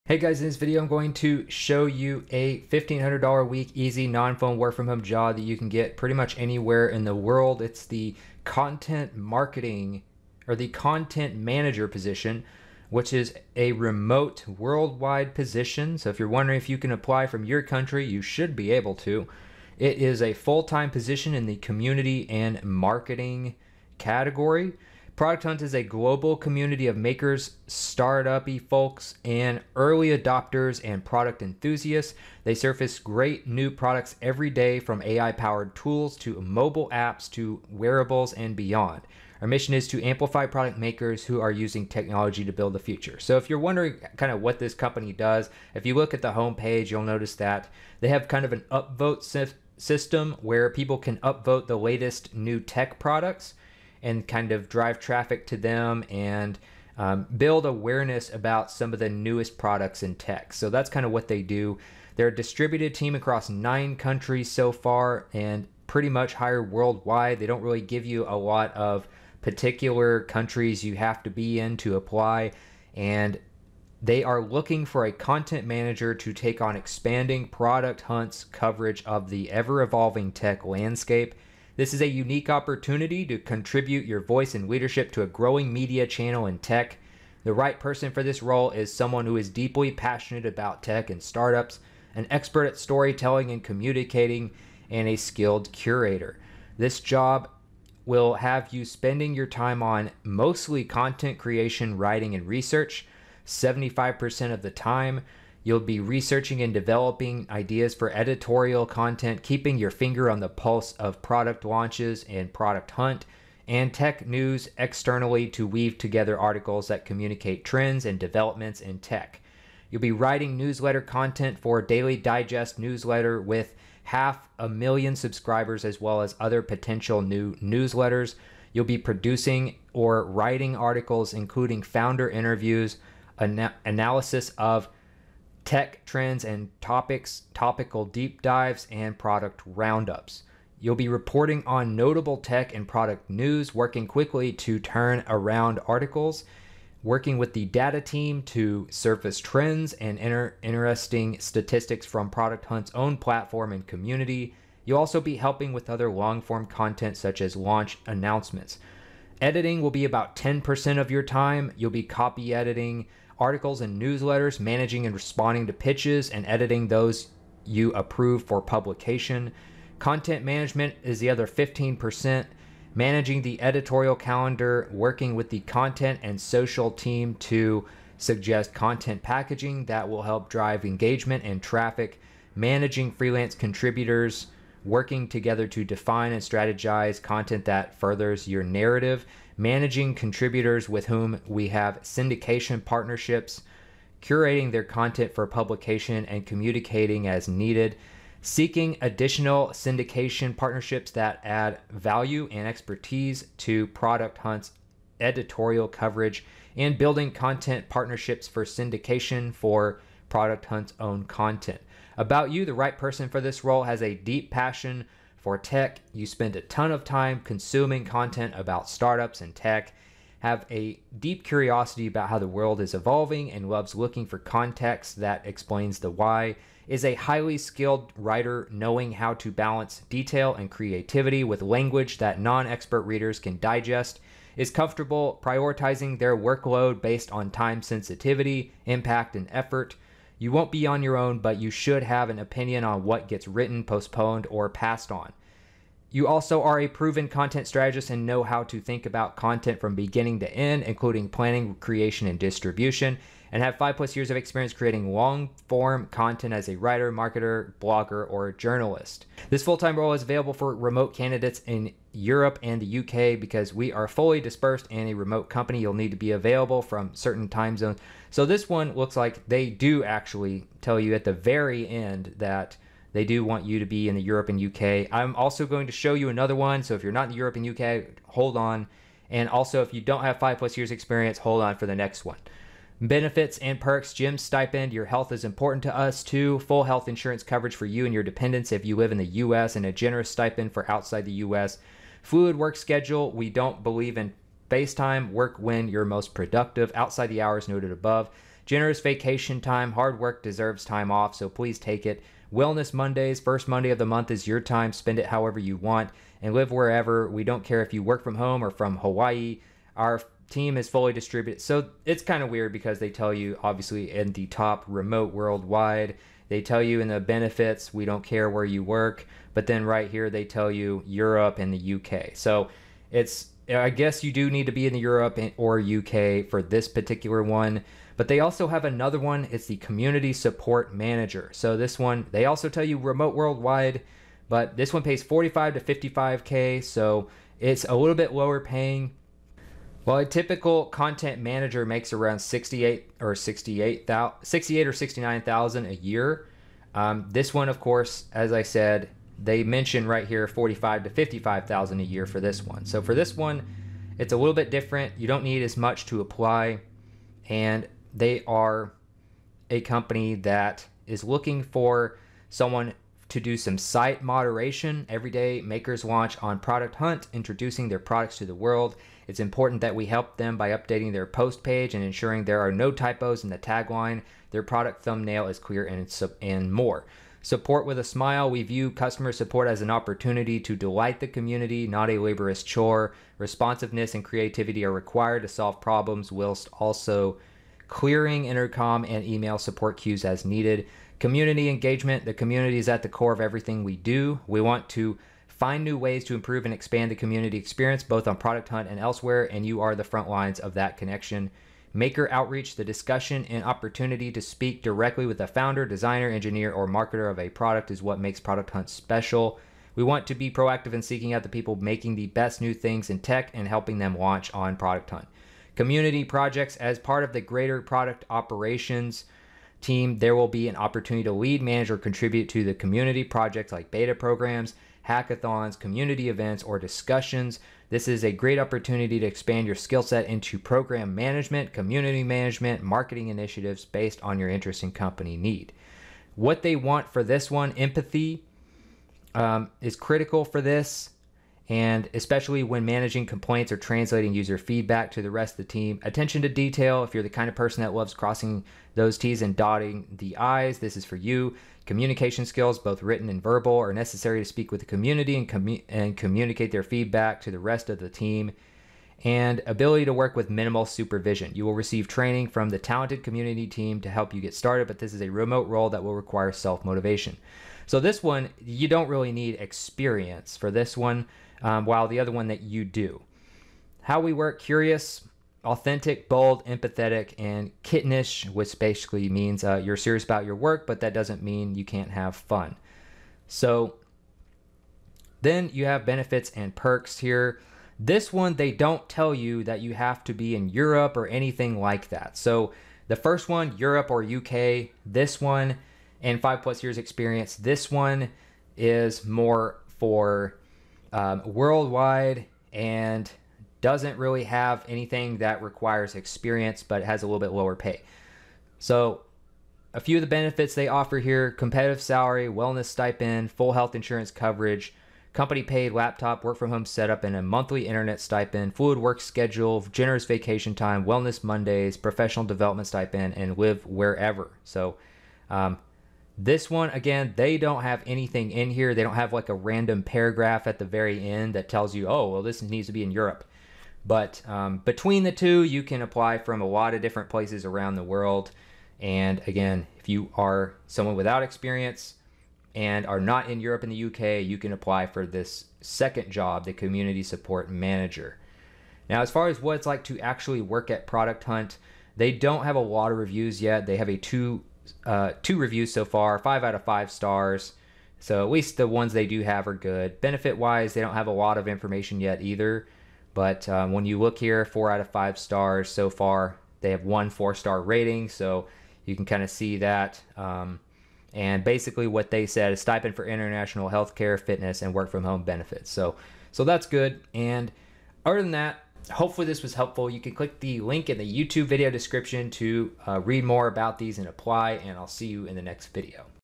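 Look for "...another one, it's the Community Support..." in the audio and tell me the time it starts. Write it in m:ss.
5:28.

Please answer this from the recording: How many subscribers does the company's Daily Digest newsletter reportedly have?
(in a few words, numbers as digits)
half a million.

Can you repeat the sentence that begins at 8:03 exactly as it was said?
So then you have benefits and perks here.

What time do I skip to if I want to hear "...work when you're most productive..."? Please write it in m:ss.
4:55.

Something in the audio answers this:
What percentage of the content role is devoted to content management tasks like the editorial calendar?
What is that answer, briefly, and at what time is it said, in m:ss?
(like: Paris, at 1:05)
15%, at 2:51.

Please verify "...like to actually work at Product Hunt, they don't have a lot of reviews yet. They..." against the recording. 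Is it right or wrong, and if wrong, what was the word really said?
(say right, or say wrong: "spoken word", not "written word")
right.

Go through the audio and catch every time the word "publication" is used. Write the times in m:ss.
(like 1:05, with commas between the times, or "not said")
2:48, 3:15.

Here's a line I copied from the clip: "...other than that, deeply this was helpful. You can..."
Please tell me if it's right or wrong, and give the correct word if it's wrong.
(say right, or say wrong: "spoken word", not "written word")
wrong: "hopefully", not "deeply".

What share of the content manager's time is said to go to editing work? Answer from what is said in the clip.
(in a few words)
10%.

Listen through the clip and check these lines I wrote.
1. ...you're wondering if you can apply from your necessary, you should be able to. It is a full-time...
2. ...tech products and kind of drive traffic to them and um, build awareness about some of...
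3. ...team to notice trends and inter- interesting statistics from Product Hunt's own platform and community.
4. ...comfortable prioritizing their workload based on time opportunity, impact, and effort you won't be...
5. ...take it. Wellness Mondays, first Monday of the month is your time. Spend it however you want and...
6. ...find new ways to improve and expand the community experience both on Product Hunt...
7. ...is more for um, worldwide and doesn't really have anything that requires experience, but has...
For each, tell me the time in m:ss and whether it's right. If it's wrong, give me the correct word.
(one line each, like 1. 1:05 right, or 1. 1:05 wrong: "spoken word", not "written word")
1. 0:16 wrong: "country", not "necessary"
2. 0:52 right
3. 2:28 wrong: "surface", not "notice"
4. 3:54 wrong: "sensitivity", not "opportunity"
5. 5:01 right
6. 6:35 right
7. 8:18 right.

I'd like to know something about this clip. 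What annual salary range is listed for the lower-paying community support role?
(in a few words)
45 to 55K.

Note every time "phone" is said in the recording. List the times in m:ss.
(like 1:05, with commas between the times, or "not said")
0:04.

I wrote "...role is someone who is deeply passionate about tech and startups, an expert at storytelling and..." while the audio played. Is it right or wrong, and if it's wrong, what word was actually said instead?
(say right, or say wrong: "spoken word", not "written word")
right.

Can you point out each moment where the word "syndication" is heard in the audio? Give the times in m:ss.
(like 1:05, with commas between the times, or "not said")
3:12, 3:19, 3:28.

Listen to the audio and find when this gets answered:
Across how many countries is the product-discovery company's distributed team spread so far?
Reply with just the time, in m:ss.
1:03.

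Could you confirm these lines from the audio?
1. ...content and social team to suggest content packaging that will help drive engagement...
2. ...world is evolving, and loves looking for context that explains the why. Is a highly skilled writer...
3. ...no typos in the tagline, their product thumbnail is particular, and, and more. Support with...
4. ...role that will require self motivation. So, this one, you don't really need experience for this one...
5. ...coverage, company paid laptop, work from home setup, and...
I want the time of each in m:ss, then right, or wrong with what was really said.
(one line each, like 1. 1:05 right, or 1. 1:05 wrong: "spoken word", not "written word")
1. 2:55 right
2. 3:42 right
3. 6:12 wrong: "clear", not "particular"
4. 7:45 right
5. 8:34 right.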